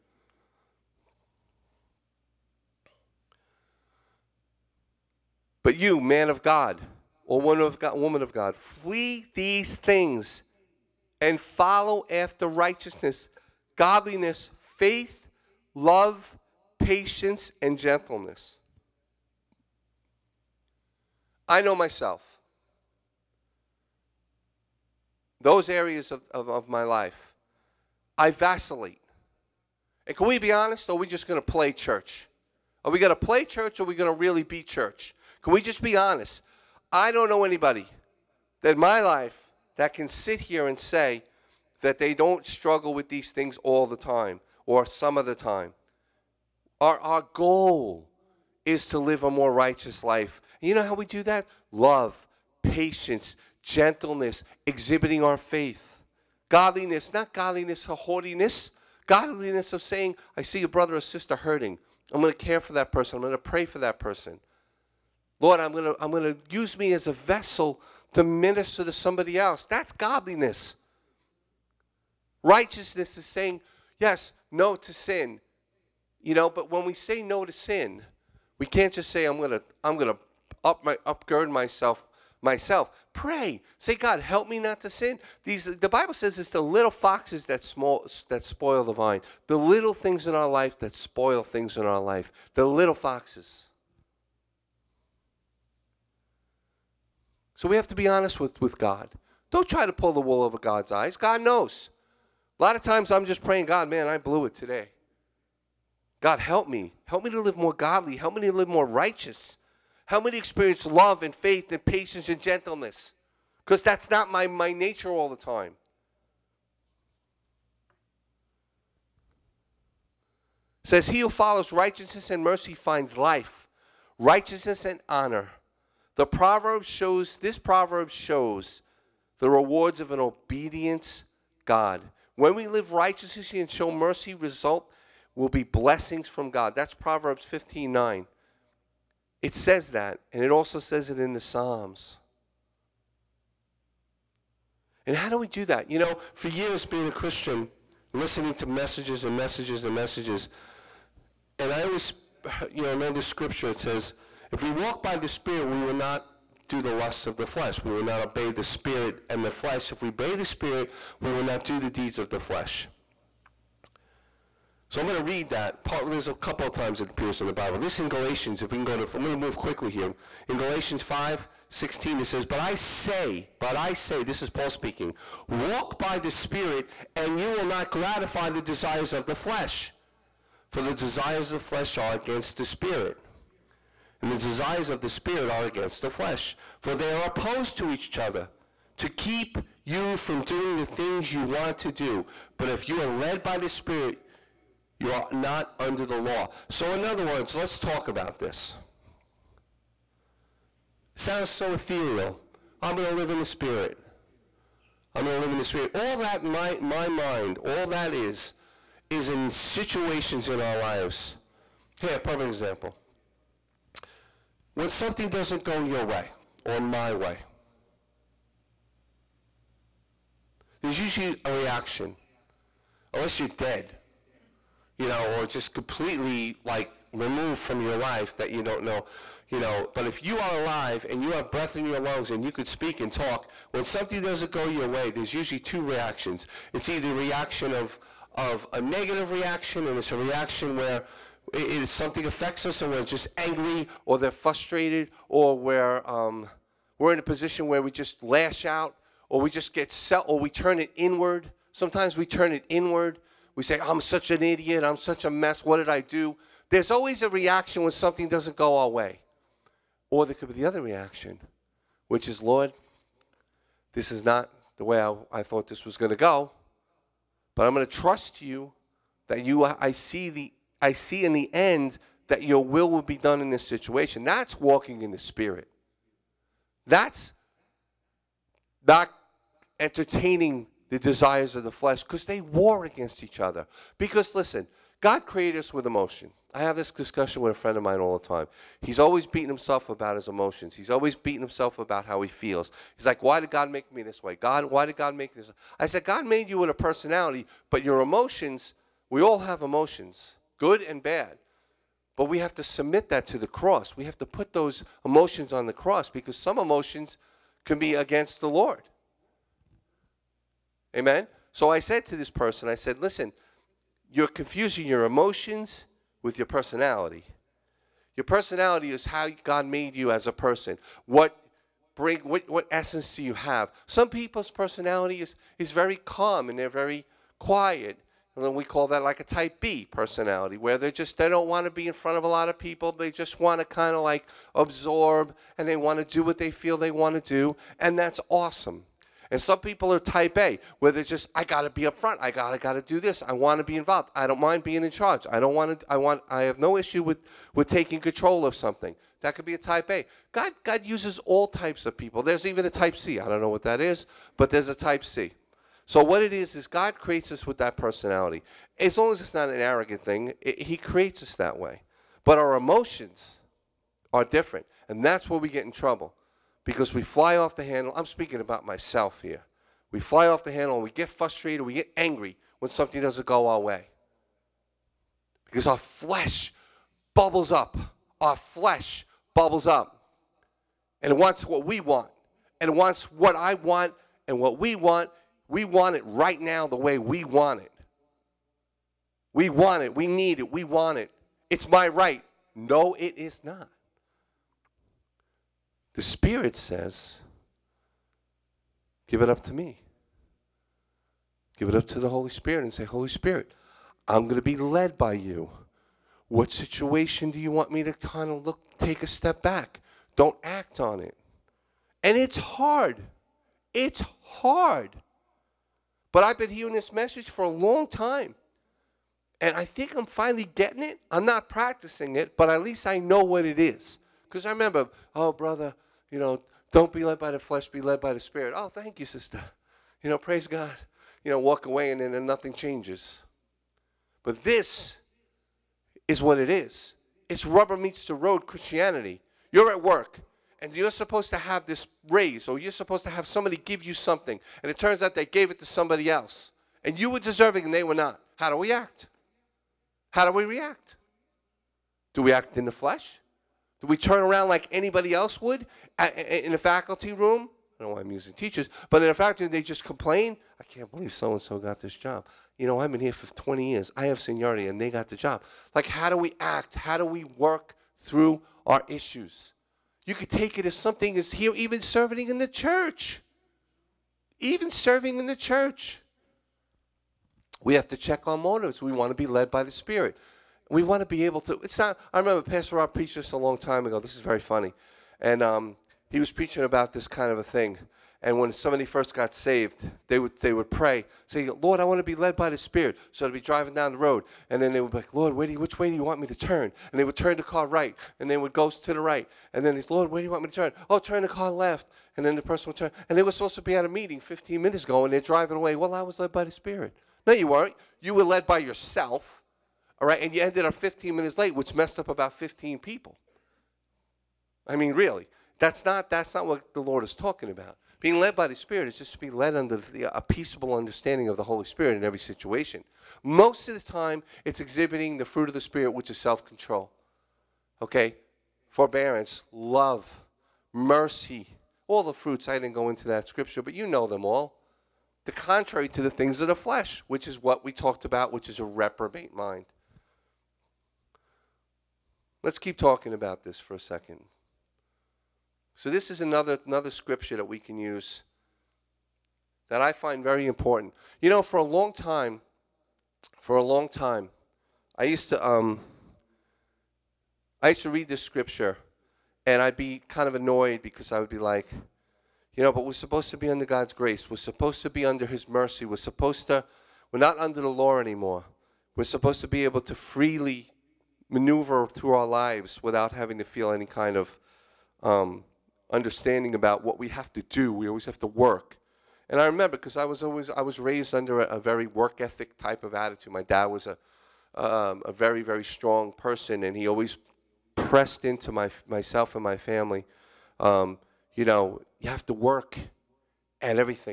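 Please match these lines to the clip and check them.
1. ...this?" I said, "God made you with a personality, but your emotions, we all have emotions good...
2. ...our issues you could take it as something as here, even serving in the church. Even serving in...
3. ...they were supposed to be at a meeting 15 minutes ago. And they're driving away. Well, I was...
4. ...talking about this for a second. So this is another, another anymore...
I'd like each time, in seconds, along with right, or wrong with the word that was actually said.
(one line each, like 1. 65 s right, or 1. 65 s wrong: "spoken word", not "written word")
1. 295 s right
2. 468 s right
3. 503 s right
4. 542 s wrong: "scripture", not "anymore".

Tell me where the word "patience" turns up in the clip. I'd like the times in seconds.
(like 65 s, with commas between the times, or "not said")
16 s, 52 s, 111 s.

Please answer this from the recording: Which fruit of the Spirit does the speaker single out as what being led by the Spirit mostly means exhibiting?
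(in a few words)
Self control.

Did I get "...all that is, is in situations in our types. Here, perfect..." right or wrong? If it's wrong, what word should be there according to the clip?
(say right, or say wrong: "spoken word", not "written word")
wrong: "lives", not "types".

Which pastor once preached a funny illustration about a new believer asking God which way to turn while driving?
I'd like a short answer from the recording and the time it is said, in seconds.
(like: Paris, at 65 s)
Pastor Rob, at 482 s.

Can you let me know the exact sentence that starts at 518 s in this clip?
Being led by the Spirit is just to be led under the, a peaceable understanding of the Holy Spirit in every situation.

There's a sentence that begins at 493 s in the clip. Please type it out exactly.
So they'd be driving down the road.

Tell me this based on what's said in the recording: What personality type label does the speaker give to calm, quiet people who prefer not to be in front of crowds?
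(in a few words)
Type B.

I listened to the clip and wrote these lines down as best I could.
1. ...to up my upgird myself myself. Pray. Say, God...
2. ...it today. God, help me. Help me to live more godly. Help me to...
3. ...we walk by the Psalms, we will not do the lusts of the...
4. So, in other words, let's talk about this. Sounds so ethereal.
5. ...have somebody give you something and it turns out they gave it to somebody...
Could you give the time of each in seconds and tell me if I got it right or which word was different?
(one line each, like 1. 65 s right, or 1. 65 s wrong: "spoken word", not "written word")
1. 80 s right
2. 104 s right
3. 154 s wrong: "Spirit", not "Psalms"
4. 196 s right
5. 443 s right.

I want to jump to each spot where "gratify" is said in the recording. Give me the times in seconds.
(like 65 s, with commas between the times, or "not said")
177 s.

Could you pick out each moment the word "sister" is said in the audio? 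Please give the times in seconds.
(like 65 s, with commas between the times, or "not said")
61 s, 429 s.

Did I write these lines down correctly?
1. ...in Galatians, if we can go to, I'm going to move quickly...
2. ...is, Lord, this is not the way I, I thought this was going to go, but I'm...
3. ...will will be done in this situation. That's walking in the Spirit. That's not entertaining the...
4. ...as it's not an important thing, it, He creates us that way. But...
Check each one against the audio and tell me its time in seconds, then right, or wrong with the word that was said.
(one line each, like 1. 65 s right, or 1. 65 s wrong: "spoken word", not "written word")
1. 167 s right
2. 262 s right
3. 272 s right
4. 359 s wrong: "arrogant", not "important".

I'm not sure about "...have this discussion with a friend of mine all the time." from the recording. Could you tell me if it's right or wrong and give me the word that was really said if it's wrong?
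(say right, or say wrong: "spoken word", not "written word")
right.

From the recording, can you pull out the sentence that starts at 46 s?
Our, our goal is to live a more righteous life.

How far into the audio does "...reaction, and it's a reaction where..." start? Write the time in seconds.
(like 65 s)
239 s.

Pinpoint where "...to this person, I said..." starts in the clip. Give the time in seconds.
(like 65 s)
312 s.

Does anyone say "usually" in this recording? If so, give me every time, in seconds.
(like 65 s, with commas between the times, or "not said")
220 s, 235 s.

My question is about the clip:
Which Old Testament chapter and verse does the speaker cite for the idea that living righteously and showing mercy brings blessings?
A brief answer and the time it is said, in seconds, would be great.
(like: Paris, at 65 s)
Proverbs 15:9, at 136 s.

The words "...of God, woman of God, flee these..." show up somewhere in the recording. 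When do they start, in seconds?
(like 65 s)
7 s.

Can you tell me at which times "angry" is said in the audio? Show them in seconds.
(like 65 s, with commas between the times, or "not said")
243 s, 371 s.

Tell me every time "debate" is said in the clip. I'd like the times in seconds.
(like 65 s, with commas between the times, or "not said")
not said.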